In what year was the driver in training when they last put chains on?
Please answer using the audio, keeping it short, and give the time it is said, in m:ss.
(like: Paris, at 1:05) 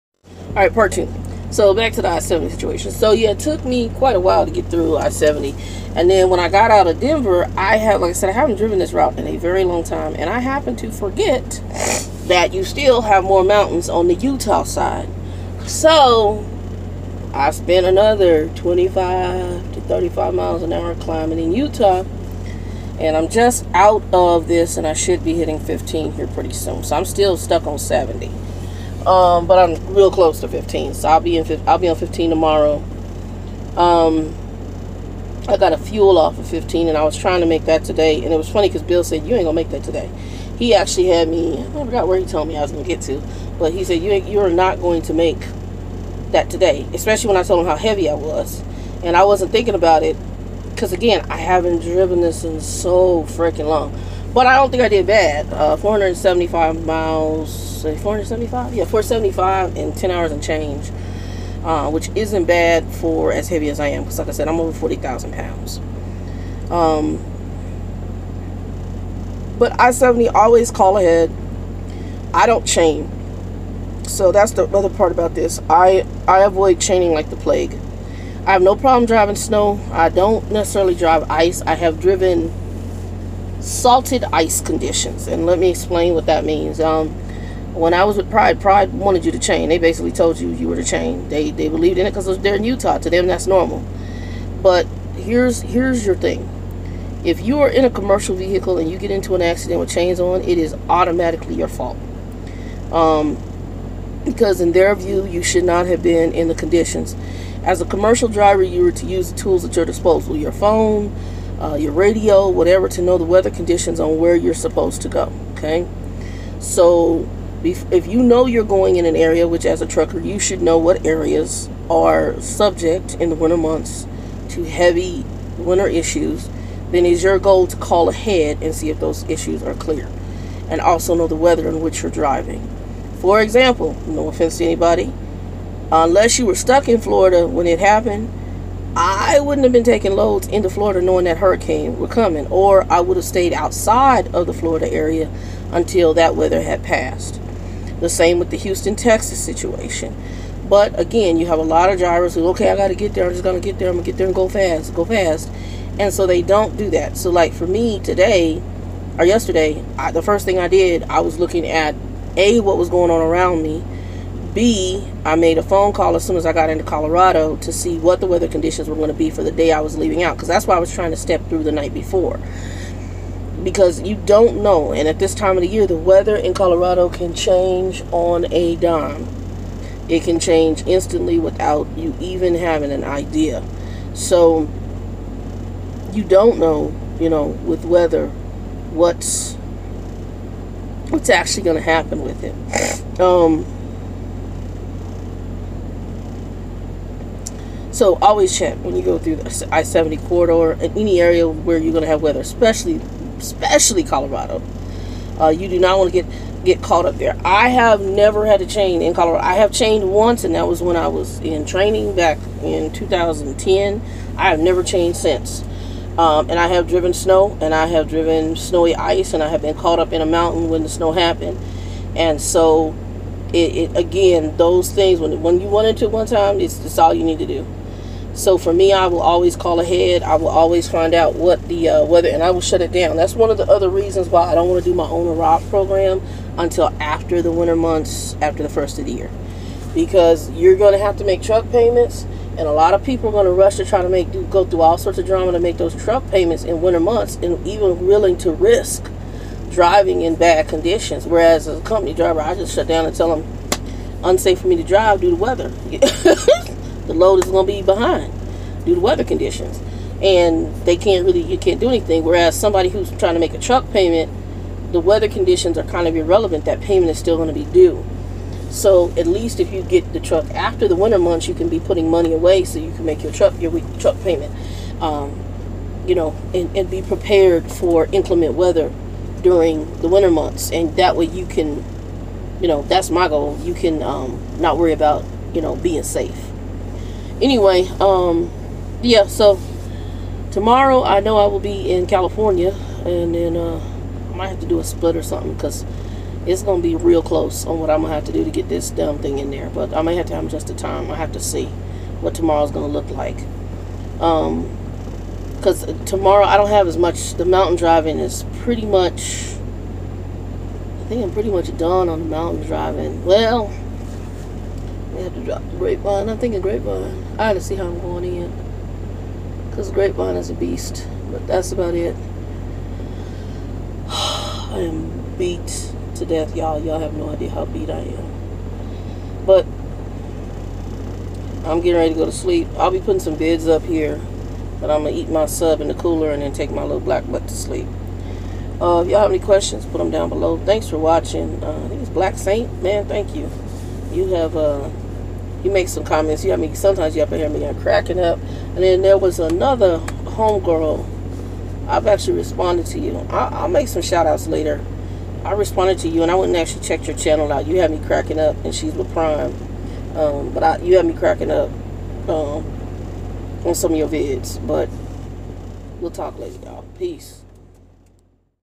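2010, at 3:32.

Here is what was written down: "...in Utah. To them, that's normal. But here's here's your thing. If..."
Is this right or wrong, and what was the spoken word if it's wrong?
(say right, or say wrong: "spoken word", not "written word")
right.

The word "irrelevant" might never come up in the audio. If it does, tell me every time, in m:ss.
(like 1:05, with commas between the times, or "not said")
4:26.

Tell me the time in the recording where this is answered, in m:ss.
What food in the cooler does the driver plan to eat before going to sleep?
5:35.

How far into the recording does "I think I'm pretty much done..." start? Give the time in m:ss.
5:11.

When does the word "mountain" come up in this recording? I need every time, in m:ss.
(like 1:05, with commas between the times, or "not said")
0:13, 3:40, 5:07, 5:12.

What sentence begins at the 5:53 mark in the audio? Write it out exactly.
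I, will make some shout outs later.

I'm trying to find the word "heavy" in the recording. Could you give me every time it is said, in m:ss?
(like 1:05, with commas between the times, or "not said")
0:47, 1:03, 2:04.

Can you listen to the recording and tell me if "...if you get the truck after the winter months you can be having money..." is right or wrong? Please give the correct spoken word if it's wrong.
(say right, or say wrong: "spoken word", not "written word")
wrong: "putting", not "having".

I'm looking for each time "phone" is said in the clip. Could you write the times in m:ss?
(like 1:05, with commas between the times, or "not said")
1:50, 2:45.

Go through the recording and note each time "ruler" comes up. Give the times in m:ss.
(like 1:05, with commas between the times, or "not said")
not said.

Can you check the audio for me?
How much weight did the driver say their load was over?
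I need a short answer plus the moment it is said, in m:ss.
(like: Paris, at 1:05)
40,000 pounds, at 1:04.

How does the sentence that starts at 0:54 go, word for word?
But I don't think I did bad.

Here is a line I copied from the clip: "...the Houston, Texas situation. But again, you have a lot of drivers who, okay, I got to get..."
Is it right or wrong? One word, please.
right.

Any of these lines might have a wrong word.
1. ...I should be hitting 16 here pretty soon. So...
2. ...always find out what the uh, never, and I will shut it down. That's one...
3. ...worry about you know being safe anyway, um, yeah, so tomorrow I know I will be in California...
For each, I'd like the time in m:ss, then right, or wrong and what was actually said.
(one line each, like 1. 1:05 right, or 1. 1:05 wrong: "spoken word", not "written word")
1. 0:24 wrong: "15", not "16"
2. 3:50 wrong: "weather", not "never"
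3. 4:44 right.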